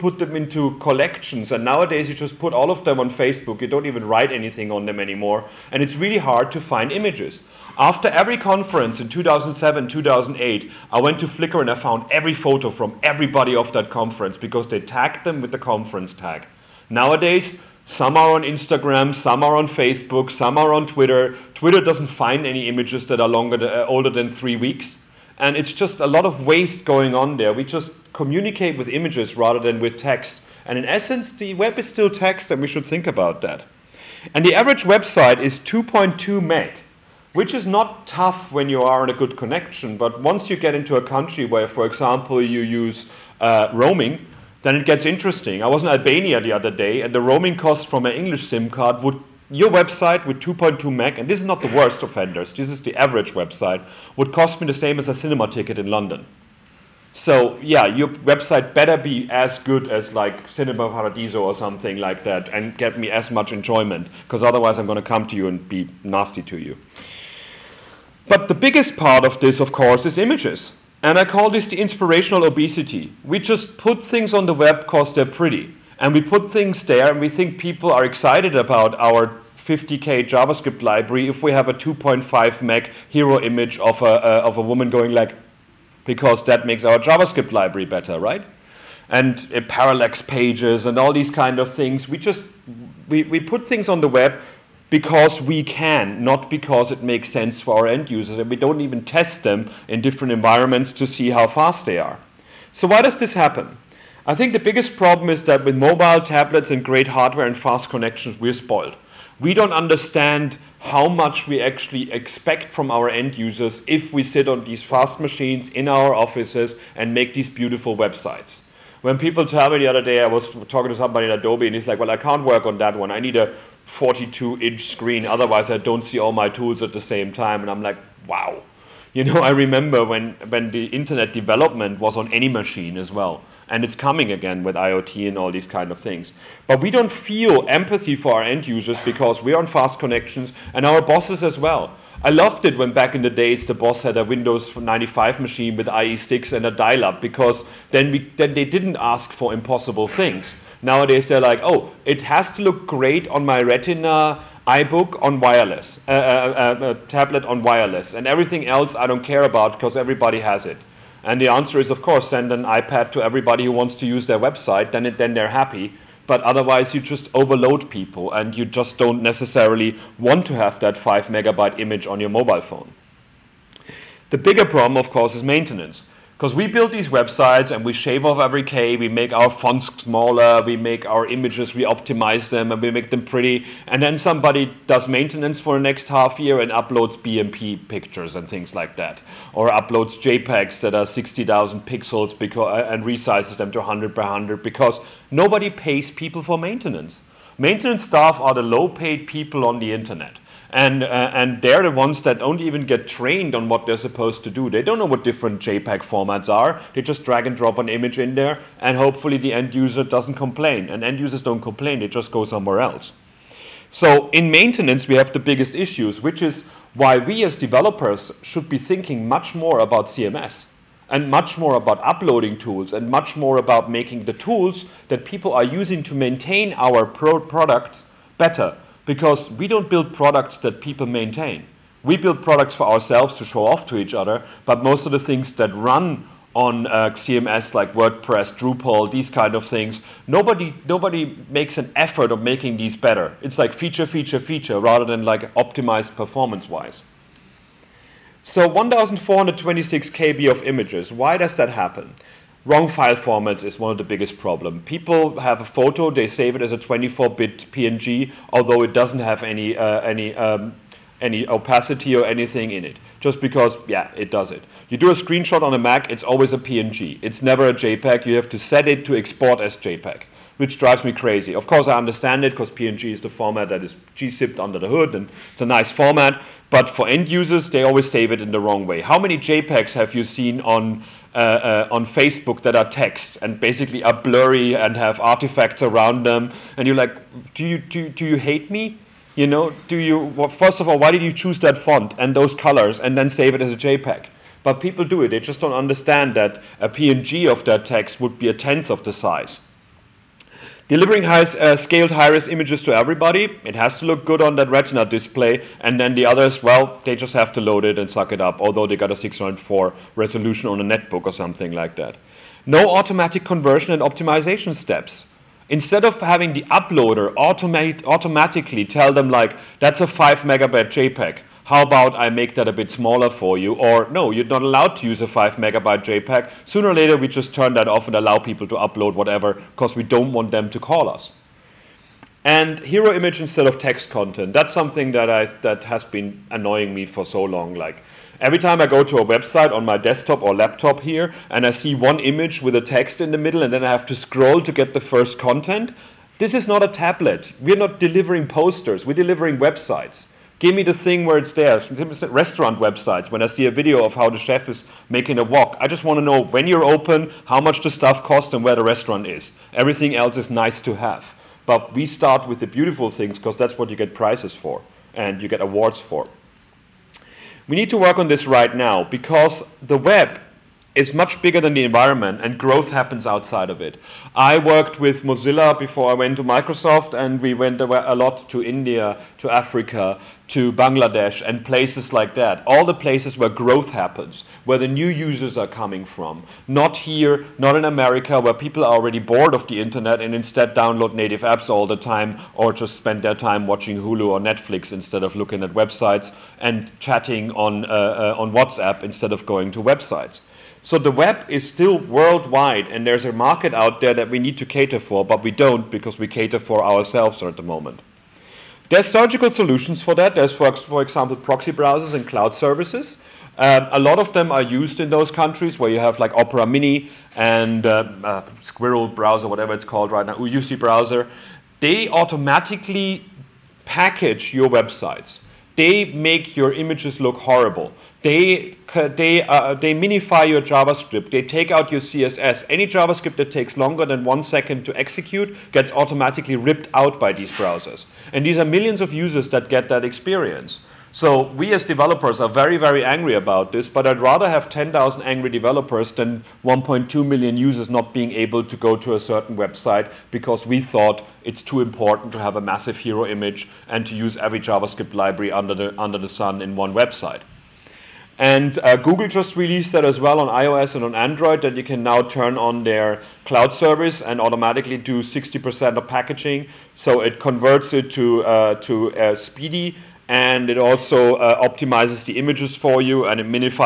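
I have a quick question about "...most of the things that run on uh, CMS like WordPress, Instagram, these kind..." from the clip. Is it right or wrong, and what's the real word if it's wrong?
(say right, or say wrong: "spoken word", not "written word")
wrong: "Drupal", not "Instagram".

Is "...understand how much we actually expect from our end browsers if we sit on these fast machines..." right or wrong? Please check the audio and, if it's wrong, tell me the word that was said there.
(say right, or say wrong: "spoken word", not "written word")
wrong: "users", not "browsers".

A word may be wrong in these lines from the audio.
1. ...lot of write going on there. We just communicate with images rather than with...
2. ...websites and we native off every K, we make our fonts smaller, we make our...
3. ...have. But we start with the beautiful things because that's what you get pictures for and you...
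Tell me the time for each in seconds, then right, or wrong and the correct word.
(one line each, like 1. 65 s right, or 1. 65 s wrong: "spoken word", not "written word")
1. 26 s wrong: "waste", not "write"
2. 177 s wrong: "shave", not "native"
3. 360 s wrong: "prizes", not "pictures".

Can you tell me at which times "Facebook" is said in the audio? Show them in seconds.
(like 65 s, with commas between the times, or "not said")
3 s, 19 s, 282 s.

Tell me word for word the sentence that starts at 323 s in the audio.
Or no, you're not allowed to use a 5 megabyte JPEG.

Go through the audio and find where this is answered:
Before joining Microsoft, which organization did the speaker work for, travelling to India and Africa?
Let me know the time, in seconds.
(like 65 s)
375 s.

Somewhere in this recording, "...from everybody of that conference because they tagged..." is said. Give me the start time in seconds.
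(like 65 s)
12 s.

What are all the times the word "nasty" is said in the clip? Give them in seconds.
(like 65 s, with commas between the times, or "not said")
66 s.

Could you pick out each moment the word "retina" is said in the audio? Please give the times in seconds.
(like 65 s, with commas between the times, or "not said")
153 s, 304 s.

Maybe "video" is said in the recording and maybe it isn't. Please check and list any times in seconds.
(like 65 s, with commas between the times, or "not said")
353 s.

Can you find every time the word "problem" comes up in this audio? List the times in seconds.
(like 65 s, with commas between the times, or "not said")
104 s, 174 s, 254 s.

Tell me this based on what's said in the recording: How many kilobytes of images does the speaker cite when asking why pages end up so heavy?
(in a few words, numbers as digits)
1,426 KB.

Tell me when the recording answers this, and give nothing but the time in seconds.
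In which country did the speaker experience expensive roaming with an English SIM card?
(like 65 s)
45 s.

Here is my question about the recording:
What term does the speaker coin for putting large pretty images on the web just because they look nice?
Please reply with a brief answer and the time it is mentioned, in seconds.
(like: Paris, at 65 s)
inspirational obesity, at 71 s.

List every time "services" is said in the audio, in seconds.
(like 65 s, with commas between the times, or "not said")
412 s, 463 s.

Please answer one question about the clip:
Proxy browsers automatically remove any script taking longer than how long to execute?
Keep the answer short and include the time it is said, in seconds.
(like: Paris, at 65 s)
1 second, at 434 s.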